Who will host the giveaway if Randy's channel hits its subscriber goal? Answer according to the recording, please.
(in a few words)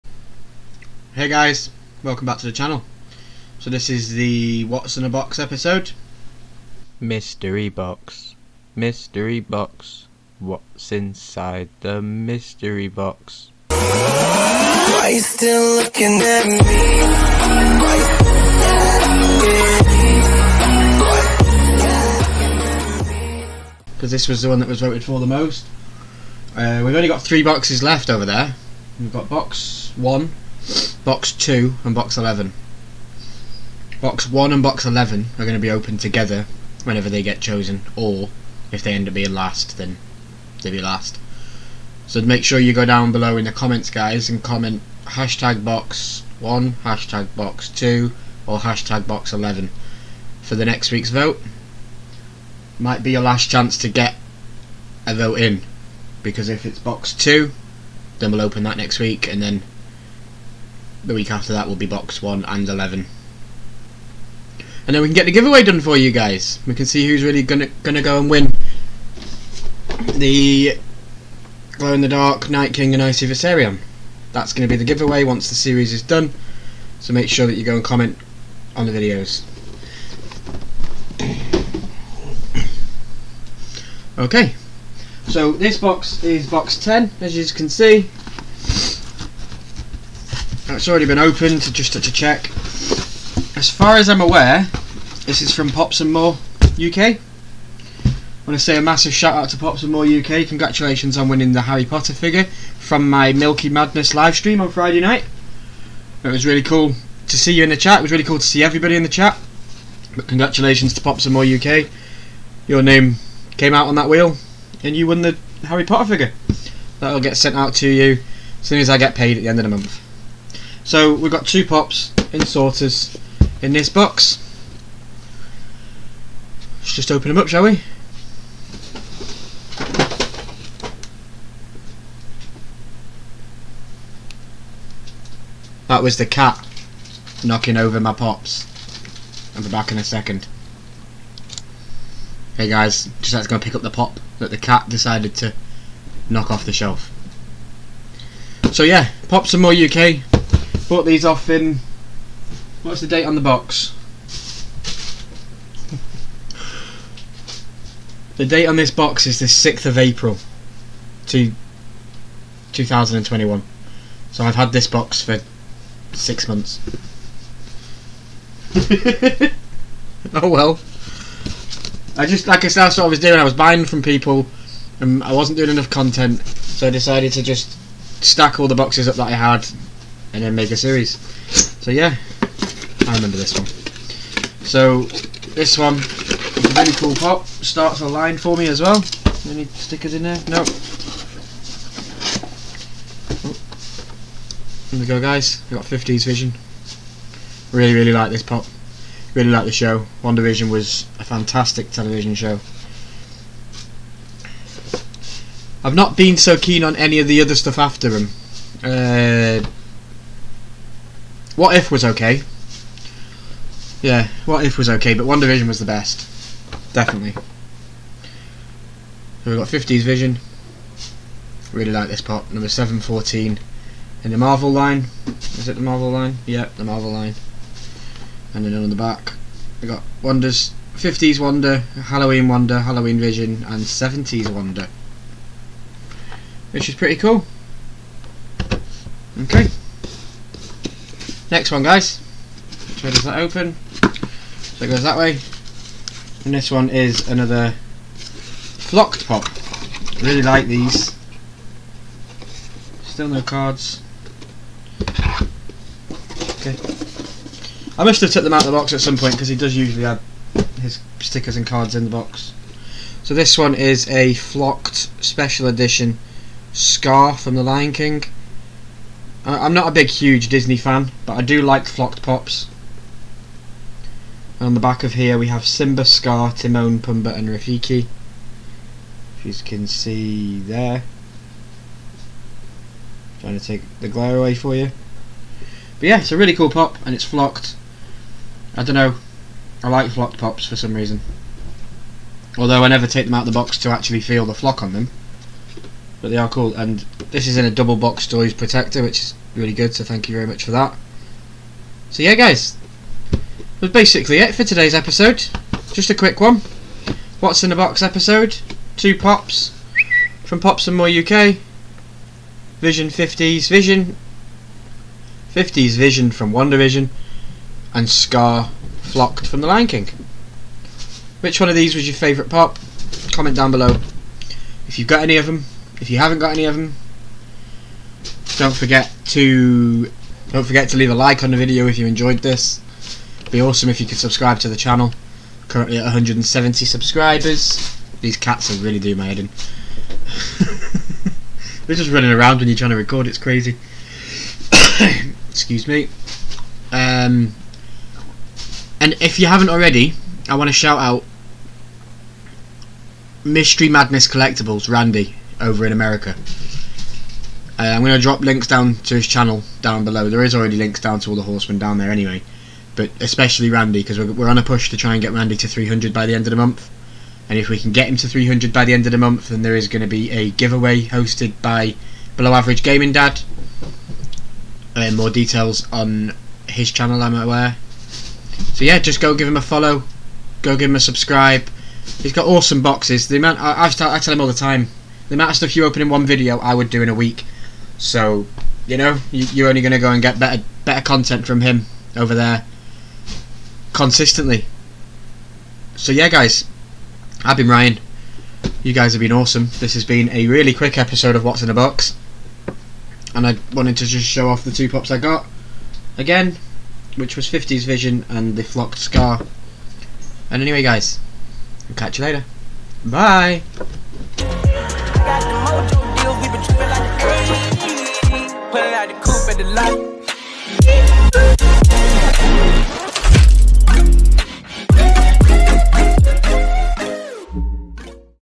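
Below Average Gaming Dad.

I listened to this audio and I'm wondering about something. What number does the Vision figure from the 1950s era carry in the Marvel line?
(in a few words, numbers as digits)
714.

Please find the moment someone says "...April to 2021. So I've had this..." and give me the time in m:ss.
2:39.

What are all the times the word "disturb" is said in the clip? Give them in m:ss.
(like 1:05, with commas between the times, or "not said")
not said.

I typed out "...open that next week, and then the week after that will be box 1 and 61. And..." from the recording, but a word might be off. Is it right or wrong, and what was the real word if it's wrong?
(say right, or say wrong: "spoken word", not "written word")
wrong: "11", not "61".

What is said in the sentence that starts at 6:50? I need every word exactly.
And anyway, guys, I'll catch you later.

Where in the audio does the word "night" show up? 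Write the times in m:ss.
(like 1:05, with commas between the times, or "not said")
1:12, 1:44.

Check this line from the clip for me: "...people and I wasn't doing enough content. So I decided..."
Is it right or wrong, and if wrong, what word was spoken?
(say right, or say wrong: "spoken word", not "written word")
right.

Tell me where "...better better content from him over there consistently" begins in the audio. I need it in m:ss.
6:30.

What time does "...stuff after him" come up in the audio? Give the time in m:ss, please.
3:27.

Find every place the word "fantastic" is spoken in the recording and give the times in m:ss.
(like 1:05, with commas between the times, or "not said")
3:21.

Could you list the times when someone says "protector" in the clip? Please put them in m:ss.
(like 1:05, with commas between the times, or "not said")
4:58.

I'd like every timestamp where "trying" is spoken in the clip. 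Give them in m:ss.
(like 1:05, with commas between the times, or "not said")
4:43, 5:42.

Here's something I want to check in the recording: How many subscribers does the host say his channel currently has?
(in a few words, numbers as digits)
170.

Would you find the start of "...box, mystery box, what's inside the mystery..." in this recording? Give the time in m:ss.
0:07.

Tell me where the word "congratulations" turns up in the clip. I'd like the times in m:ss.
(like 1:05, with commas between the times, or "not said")
1:40, 1:50.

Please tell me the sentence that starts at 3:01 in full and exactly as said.
So yeah, I remember this one.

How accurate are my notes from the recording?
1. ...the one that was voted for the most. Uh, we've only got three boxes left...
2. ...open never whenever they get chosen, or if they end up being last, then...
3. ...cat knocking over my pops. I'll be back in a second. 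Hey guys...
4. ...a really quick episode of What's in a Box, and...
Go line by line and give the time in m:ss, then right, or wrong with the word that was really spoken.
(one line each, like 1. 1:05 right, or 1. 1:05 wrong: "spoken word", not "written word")
1. 0:24 right
2. 0:35 wrong: "together", not "never"
3. 2:16 right
4. 6:40 right.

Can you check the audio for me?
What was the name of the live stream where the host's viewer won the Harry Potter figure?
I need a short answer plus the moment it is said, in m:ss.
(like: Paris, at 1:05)
Milky Madness, at 1:43.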